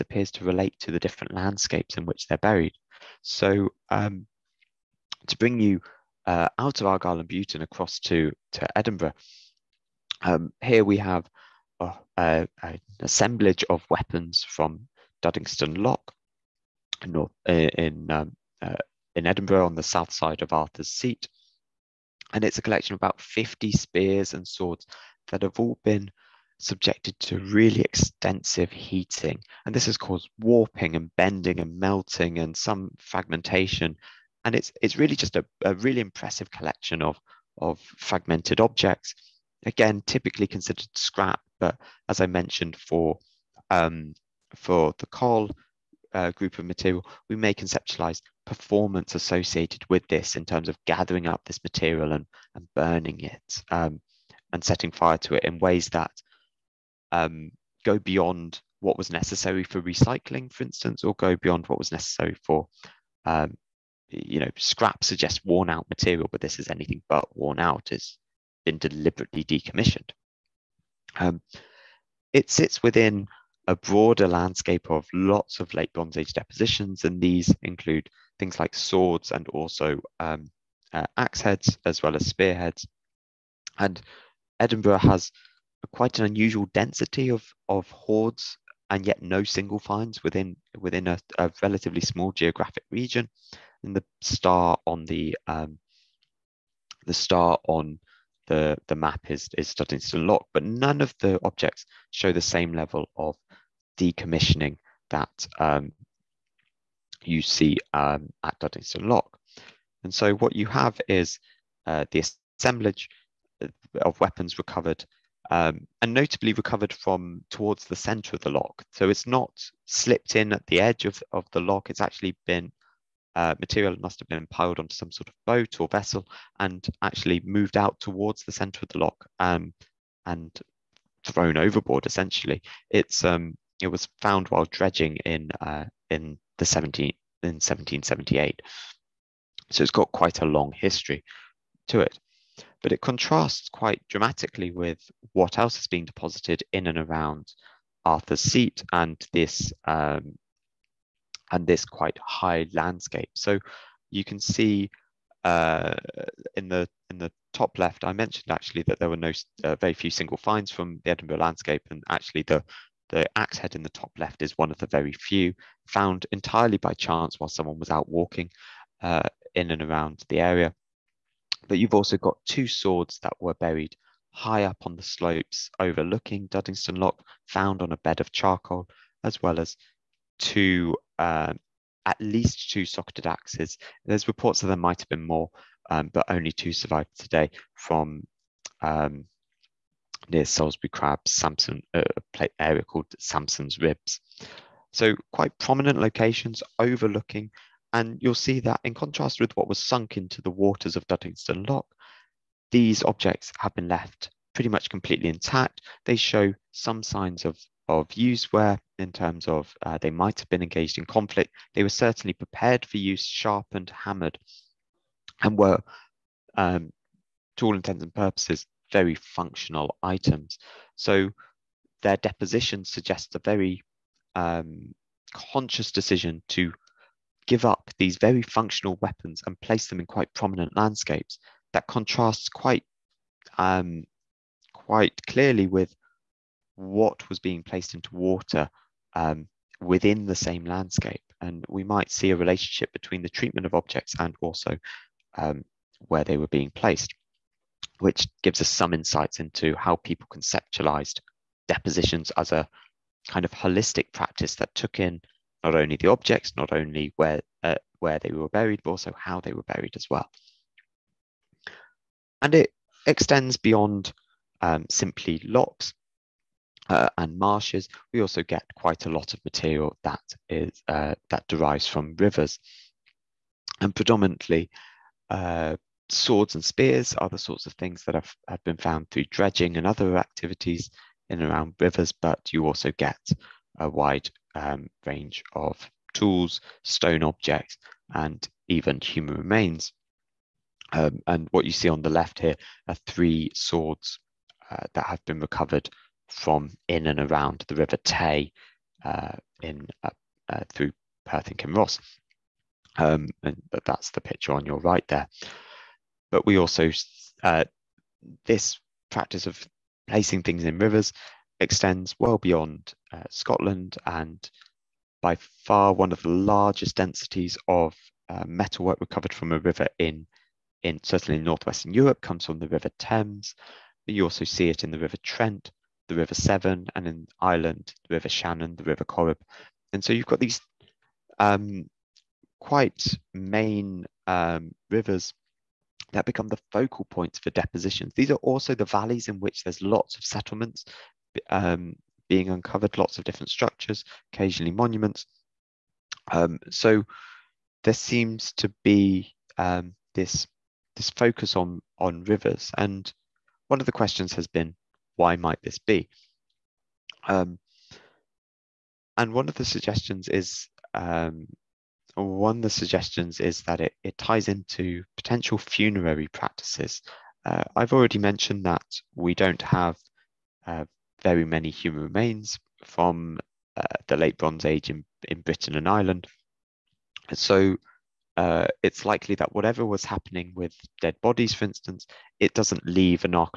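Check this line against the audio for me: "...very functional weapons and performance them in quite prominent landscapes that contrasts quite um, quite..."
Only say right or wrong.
wrong.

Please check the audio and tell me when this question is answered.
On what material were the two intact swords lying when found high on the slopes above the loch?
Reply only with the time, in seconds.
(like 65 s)
177 s.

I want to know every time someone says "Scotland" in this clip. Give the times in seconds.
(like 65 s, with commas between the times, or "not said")
313 s.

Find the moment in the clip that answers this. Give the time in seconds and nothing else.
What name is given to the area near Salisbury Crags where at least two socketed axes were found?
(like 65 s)
193 s.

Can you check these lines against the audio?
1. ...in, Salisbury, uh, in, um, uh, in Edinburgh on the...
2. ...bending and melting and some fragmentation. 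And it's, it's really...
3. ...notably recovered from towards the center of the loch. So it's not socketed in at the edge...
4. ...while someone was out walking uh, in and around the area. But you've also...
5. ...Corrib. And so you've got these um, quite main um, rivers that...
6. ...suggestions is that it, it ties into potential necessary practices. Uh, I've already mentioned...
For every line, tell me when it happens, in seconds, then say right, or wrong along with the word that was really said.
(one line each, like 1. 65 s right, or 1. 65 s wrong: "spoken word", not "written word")
1. 17 s wrong: "North", not "Salisbury"
2. 31 s right
3. 116 s wrong: "slipped", not "socketed"
4. 167 s right
5. 329 s right
6. 362 s wrong: "funerary", not "necessary".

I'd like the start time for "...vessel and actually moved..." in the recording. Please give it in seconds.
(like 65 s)
125 s.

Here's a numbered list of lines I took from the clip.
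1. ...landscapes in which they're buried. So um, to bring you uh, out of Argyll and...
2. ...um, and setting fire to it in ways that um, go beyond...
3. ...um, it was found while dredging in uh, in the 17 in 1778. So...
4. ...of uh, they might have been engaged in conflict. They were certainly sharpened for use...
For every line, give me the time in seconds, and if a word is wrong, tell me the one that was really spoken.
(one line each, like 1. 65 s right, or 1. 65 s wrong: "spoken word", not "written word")
1. 1 s right
2. 53 s right
3. 133 s right
4. 209 s wrong: "prepared", not "sharpened".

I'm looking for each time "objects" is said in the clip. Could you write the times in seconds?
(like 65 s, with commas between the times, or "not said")
38 s, 101 s, 203 s, 243 s, 256 s, 287 s.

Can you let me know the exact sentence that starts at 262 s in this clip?
And it extends beyond um, simply lochs uh, and marshes.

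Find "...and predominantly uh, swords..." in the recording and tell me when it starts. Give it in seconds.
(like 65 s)
273 s.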